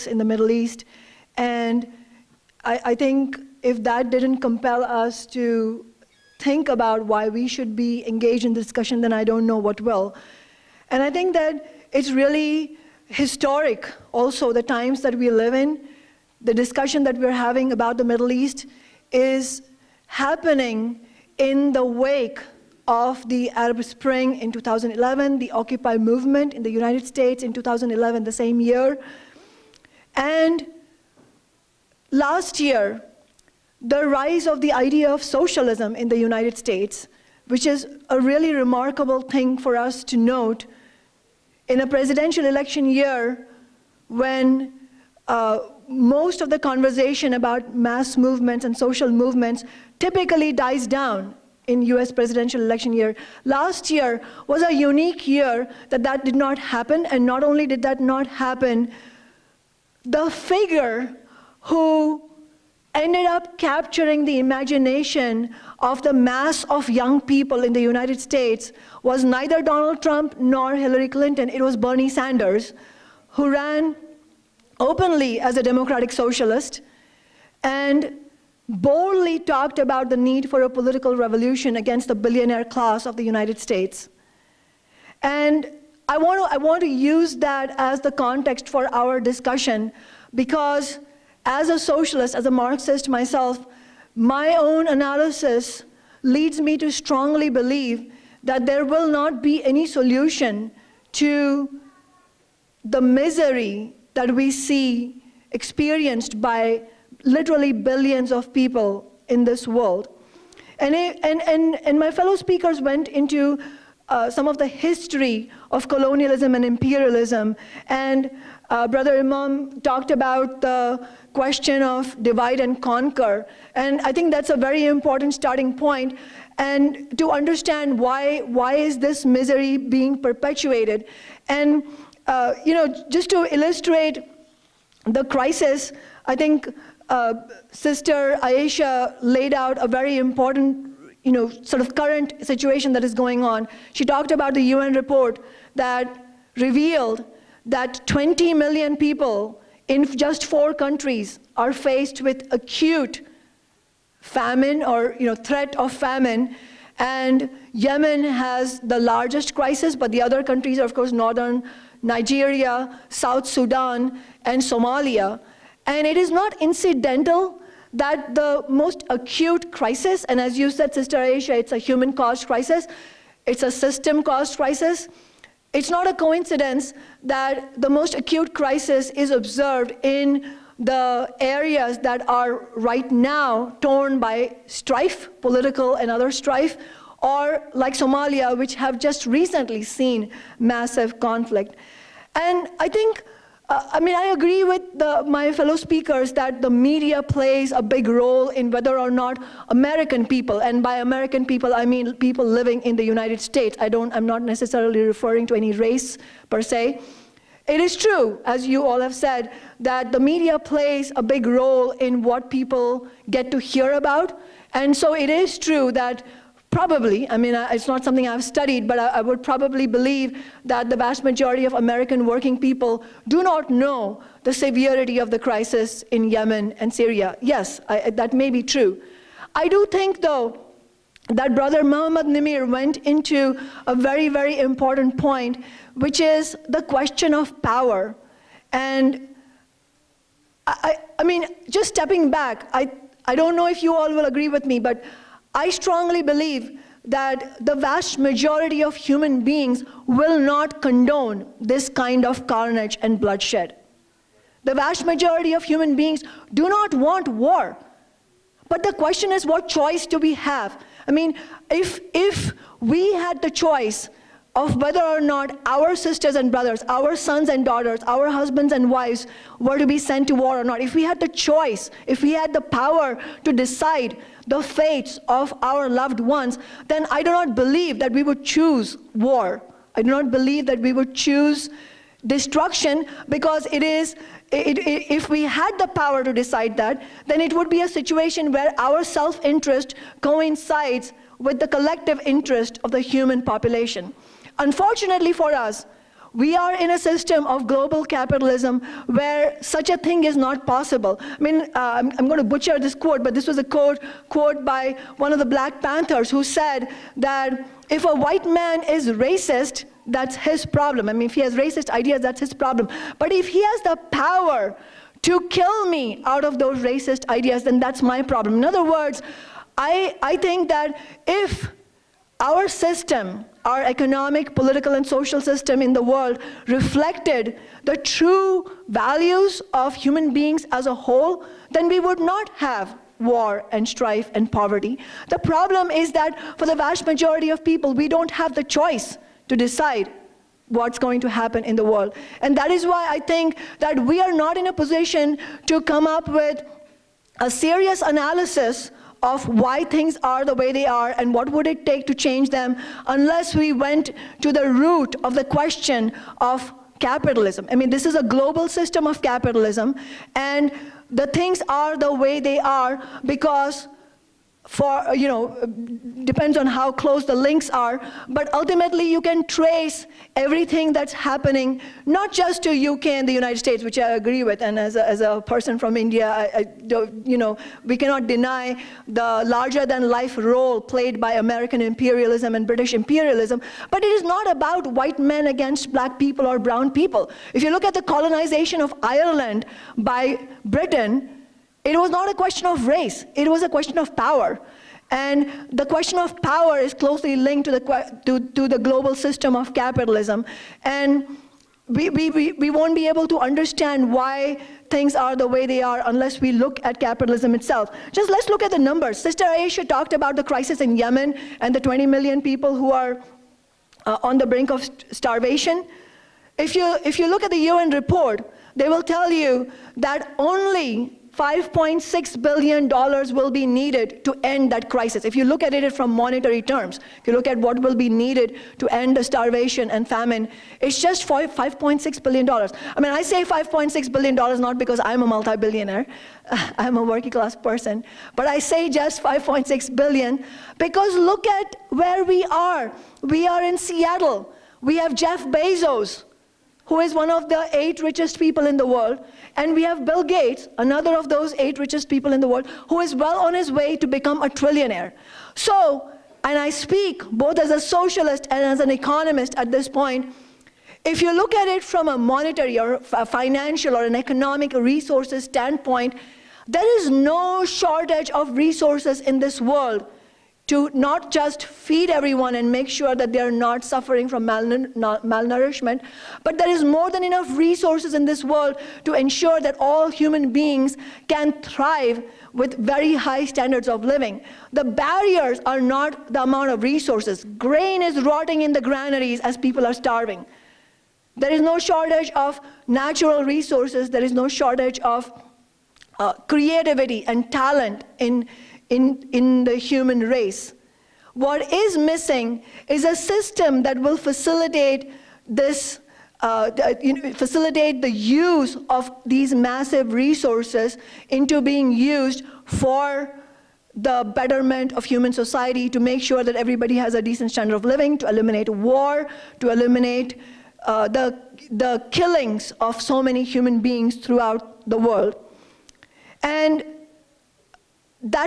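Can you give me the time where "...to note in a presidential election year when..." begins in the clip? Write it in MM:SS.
00:40.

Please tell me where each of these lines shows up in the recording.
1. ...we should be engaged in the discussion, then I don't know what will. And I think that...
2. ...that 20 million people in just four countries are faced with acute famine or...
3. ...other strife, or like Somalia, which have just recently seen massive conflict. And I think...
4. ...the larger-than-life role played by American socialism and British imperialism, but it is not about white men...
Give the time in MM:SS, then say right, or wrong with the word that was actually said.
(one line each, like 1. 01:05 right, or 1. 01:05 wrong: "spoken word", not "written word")
1. 00:07 right
2. 02:27 right
3. 03:06 right
4. 06:19 wrong: "imperialism", not "socialism".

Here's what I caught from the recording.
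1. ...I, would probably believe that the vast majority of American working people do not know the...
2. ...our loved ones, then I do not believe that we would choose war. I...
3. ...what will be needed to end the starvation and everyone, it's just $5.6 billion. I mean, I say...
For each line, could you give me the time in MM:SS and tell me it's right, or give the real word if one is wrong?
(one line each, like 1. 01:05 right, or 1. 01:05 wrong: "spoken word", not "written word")
1. 03:38 right
2. 04:35 right
3. 07:07 wrong: "famine", not "everyone".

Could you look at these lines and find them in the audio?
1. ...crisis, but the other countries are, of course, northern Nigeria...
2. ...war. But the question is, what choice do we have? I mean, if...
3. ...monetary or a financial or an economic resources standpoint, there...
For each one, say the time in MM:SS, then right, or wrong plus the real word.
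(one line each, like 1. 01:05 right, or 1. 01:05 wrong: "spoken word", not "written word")
1. 02:39 right
2. 04:17 right
3. 07:42 right.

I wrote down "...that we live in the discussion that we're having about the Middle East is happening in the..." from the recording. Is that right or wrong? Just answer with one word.
right.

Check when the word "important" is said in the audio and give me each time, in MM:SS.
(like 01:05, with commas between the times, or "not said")
02:04, 02:20, 03:54.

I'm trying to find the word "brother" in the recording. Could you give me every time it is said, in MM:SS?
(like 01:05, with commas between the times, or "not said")
01:58, 03:51, 04:26.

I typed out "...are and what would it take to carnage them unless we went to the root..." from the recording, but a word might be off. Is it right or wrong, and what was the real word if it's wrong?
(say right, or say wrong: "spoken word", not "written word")
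wrong: "change", not "carnage".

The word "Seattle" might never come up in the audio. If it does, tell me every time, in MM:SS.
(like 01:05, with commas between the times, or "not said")
07:23.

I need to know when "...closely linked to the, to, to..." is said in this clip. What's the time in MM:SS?
06:36.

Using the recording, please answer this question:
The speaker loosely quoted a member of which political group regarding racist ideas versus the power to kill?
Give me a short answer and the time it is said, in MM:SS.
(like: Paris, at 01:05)
Black Panthers, at 05:05.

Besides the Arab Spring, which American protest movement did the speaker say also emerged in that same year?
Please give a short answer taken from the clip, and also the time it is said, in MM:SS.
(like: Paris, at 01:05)
Occupy movement, at 00:25.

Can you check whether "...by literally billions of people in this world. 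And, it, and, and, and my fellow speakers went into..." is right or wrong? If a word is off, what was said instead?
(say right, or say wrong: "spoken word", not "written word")
right.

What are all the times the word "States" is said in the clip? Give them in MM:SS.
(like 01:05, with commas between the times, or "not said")
00:27, 00:36, 01:08, 01:23, 03:23, 06:13.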